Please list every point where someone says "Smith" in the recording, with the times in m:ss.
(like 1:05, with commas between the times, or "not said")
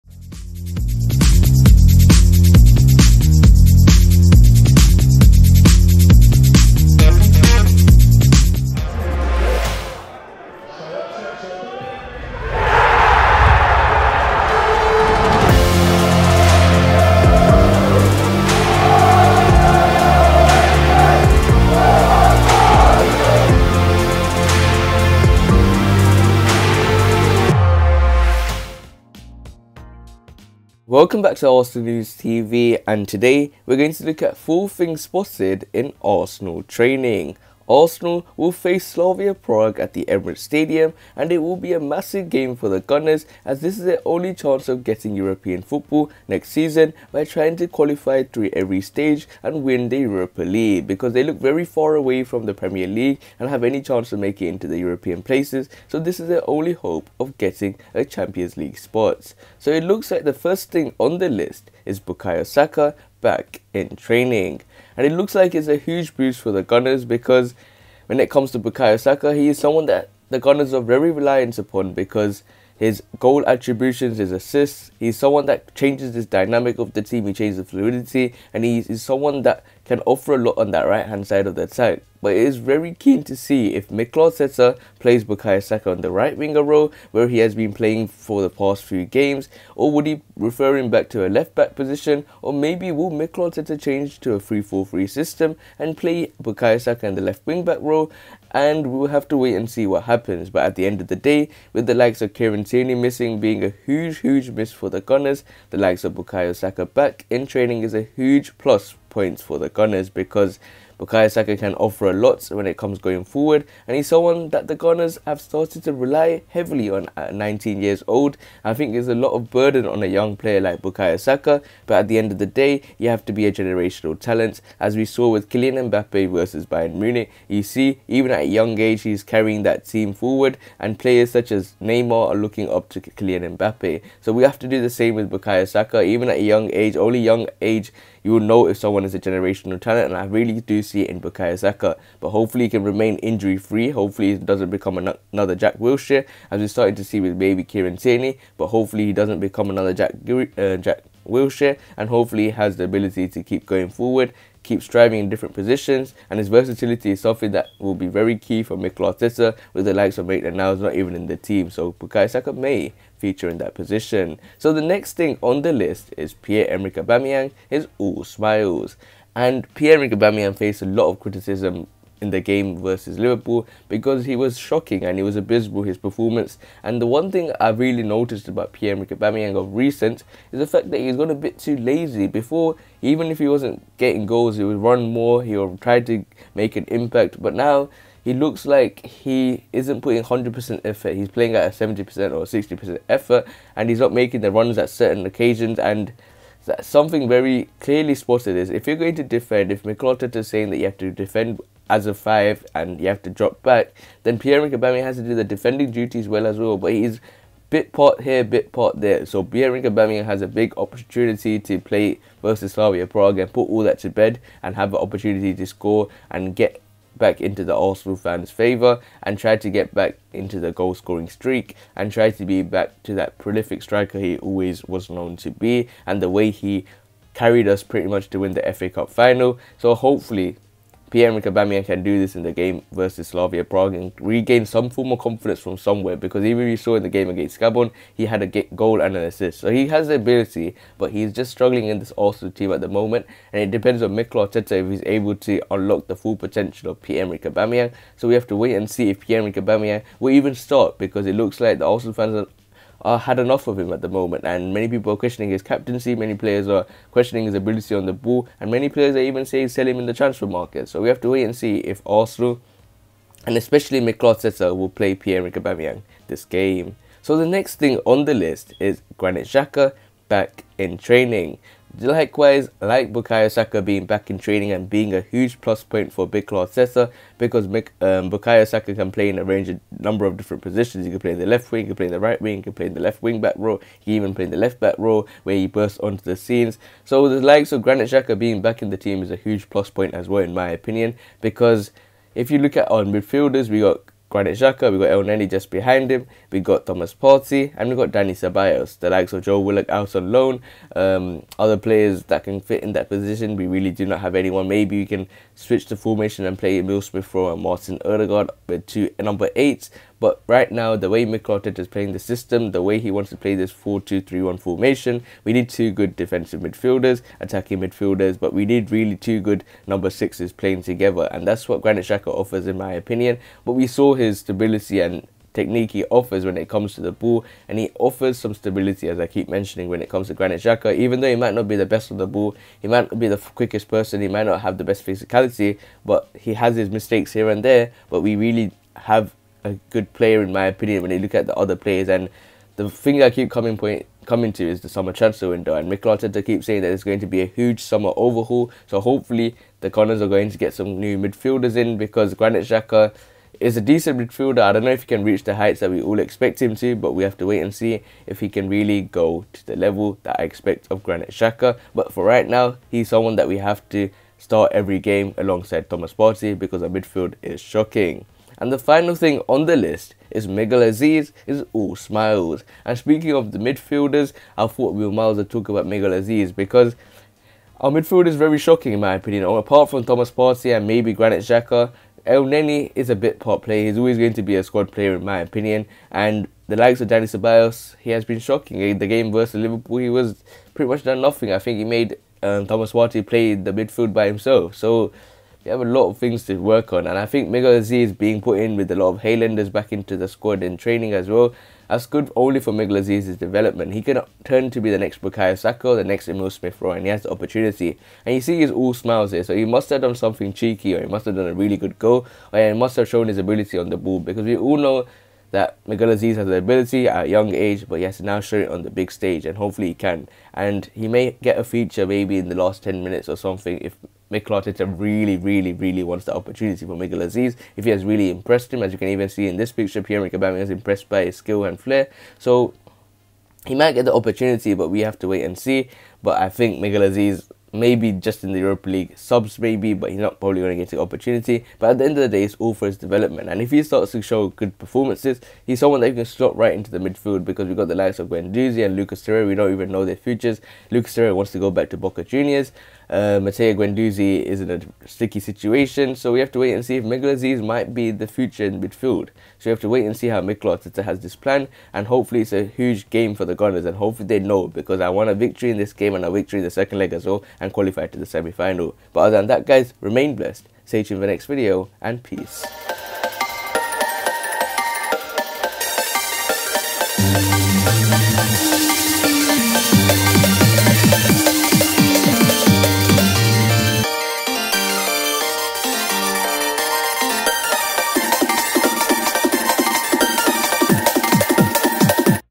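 5:07, 6:46.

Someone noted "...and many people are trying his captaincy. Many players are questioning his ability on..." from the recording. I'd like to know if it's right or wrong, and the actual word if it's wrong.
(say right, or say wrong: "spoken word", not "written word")
wrong: "questioning", not "trying".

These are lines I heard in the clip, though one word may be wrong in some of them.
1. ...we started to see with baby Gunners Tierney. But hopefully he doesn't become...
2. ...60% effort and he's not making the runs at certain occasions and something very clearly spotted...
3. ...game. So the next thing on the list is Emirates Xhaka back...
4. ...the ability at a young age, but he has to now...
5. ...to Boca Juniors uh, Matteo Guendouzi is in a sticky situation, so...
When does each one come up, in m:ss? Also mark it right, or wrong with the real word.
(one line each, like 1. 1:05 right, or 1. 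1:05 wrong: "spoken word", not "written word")
1. 2:26 wrong: "Kieran", not "Gunners"
2. 3:12 right
3. 4:26 wrong: "Granit", not "Emirates"
4. 6:56 right
5. 7:31 right.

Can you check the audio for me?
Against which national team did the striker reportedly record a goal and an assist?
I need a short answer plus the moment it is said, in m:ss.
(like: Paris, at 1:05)
Gabon, at 3:57.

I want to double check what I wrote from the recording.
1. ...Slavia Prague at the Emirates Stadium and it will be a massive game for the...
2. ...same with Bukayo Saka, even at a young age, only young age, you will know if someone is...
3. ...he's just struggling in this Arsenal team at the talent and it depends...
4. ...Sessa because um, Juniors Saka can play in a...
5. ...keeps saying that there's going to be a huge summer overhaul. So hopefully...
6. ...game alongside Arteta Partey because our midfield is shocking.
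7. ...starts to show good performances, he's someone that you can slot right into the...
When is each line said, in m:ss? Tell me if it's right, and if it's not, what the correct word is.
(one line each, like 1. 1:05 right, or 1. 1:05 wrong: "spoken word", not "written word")
1. 0:38 right
2. 2:14 right
3. 4:01 wrong: "moment", not "talent"
4. 4:36 wrong: "Bukayo", not "Juniors"
5. 5:46 right
6. 6:04 wrong: "Thomas", not "Arteta"
7. 7:23 right.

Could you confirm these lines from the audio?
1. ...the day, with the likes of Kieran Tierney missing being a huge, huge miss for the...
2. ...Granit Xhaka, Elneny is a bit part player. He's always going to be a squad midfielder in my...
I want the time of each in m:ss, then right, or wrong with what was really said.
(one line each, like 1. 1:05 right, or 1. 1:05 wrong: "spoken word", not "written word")
1. 1:41 right
2. 6:21 wrong: "player", not "midfielder".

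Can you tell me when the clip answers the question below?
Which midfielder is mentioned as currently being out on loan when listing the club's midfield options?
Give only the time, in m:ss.
4:59.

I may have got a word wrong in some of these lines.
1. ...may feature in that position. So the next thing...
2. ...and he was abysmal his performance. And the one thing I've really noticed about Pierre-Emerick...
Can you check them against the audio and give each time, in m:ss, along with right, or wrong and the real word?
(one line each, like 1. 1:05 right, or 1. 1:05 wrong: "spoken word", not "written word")
1. 2:42 right
2. 2:55 right.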